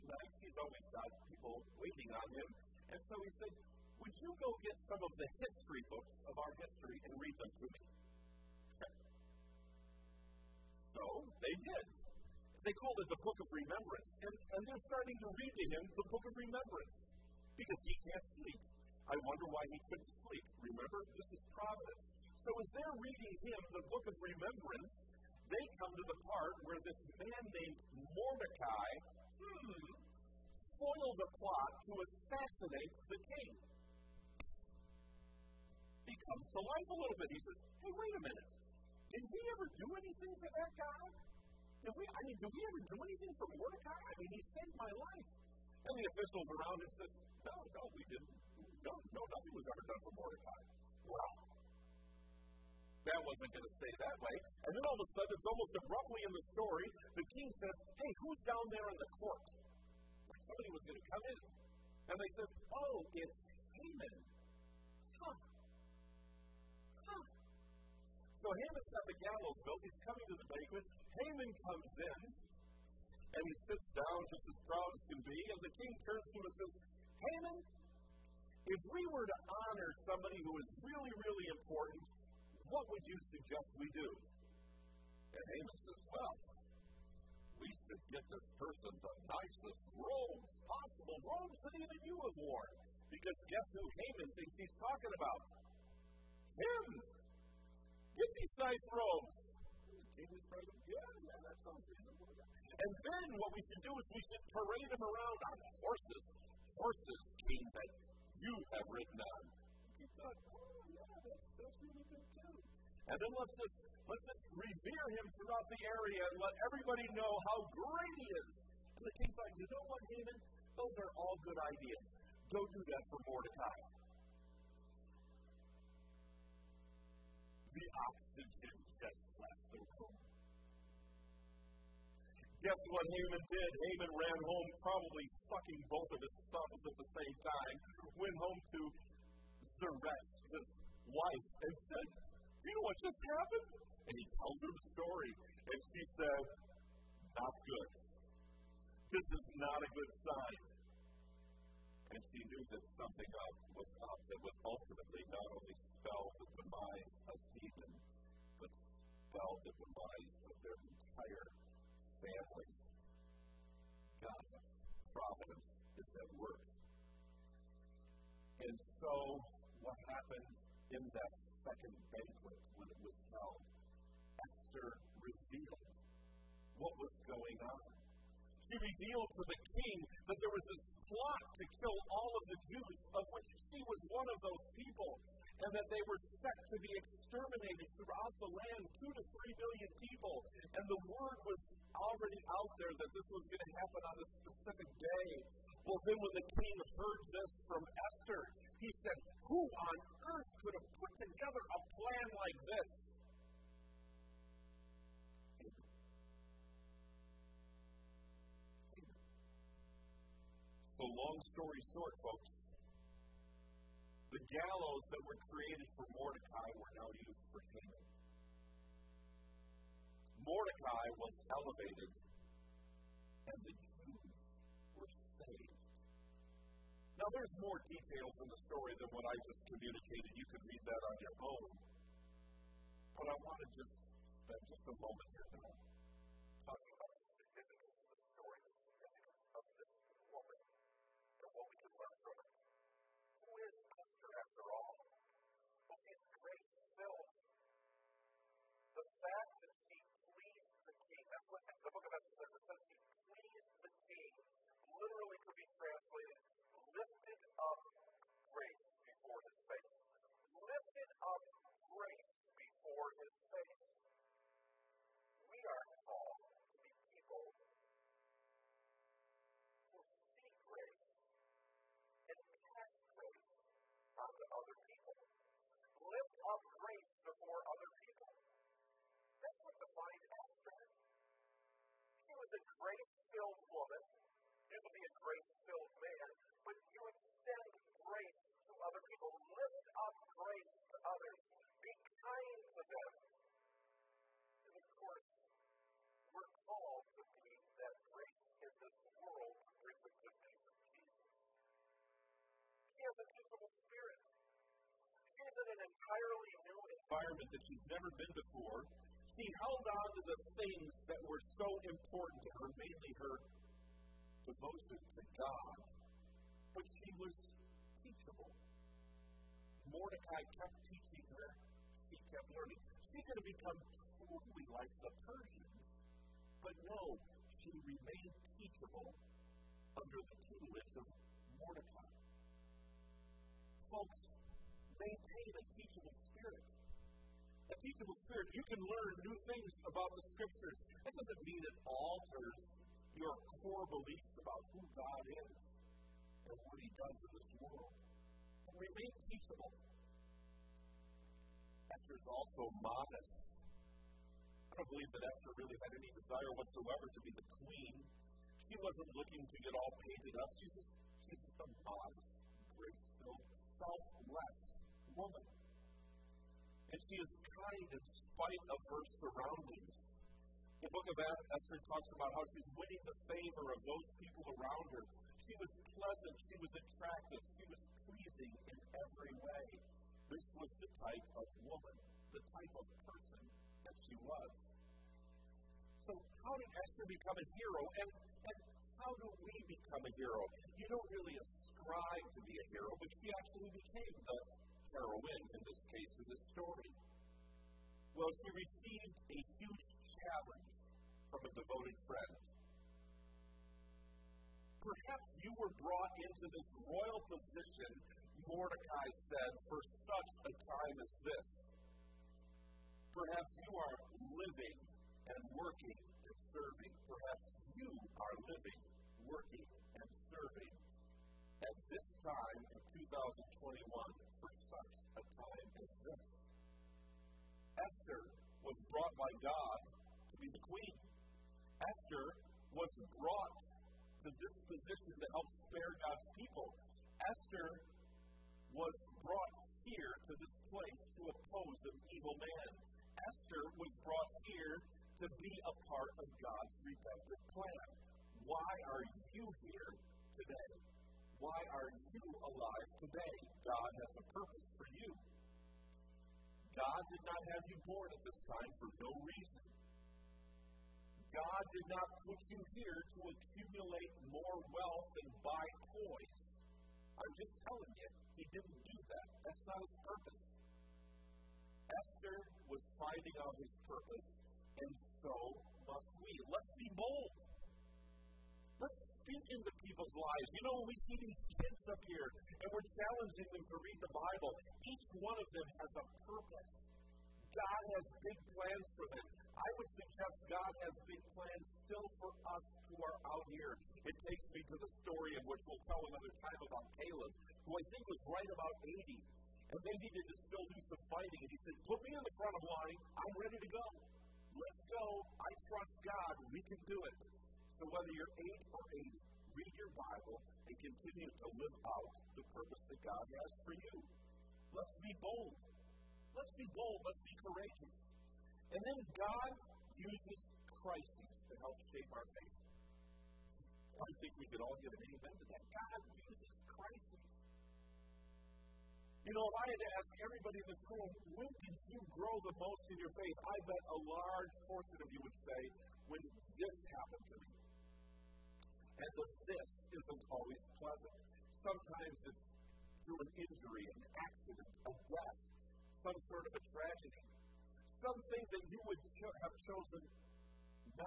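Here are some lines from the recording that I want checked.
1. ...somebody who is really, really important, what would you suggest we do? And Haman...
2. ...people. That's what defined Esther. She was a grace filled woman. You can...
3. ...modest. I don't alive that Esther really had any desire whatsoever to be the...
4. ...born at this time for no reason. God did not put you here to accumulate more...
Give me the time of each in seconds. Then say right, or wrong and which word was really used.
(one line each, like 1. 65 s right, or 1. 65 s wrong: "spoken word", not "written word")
1. 80 s right
2. 278 s right
3. 352 s wrong: "believe", not "alive"
4. 457 s right.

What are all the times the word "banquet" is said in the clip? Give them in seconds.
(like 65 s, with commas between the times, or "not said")
70 s, 172 s.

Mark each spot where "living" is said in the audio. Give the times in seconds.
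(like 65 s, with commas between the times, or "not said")
414 s, 418 s.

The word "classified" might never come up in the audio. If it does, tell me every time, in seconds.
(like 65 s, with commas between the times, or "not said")
not said.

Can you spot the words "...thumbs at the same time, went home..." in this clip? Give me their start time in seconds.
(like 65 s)
136 s.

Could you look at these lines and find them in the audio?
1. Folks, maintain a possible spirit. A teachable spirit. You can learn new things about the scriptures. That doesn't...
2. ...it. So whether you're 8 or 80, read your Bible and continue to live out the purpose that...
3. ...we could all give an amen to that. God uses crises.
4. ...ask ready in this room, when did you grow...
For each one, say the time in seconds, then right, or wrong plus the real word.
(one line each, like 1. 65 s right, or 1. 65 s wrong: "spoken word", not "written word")
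1. 333 s wrong: "teachable", not "possible"
2. 507 s right
3. 524 s right
4. 529 s wrong: "everybody", not "ready".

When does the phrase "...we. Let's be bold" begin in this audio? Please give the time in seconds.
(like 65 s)
476 s.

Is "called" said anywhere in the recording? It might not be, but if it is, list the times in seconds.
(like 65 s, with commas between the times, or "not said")
12 s, 266 s, 296 s.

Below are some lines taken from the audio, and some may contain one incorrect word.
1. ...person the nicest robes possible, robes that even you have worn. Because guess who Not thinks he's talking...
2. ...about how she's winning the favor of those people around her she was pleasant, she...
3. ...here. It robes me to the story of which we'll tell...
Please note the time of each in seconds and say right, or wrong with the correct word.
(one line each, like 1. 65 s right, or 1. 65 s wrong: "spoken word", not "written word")
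1. 88 s wrong: "Haman", not "Not"
2. 372 s right
3. 493 s wrong: "takes", not "robes".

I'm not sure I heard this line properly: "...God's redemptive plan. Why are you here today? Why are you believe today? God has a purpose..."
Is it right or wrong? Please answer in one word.
wrong.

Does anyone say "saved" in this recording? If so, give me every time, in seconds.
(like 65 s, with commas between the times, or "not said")
44 s, 225 s.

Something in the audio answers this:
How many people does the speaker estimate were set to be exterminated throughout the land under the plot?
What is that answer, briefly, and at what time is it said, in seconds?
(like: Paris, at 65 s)
2 to 3 million, at 189 s.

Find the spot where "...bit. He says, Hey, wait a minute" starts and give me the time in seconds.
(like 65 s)
37 s.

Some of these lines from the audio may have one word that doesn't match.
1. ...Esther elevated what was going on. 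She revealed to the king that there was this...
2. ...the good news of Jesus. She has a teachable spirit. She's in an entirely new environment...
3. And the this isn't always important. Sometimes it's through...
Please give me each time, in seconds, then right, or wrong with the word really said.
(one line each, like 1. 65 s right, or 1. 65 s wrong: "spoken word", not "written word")
1. 174 s wrong: "revealed", not "elevated"
2. 300 s right
3. 538 s wrong: "pleasant", not "important".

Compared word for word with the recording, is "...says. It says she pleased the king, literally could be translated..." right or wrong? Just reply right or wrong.
right.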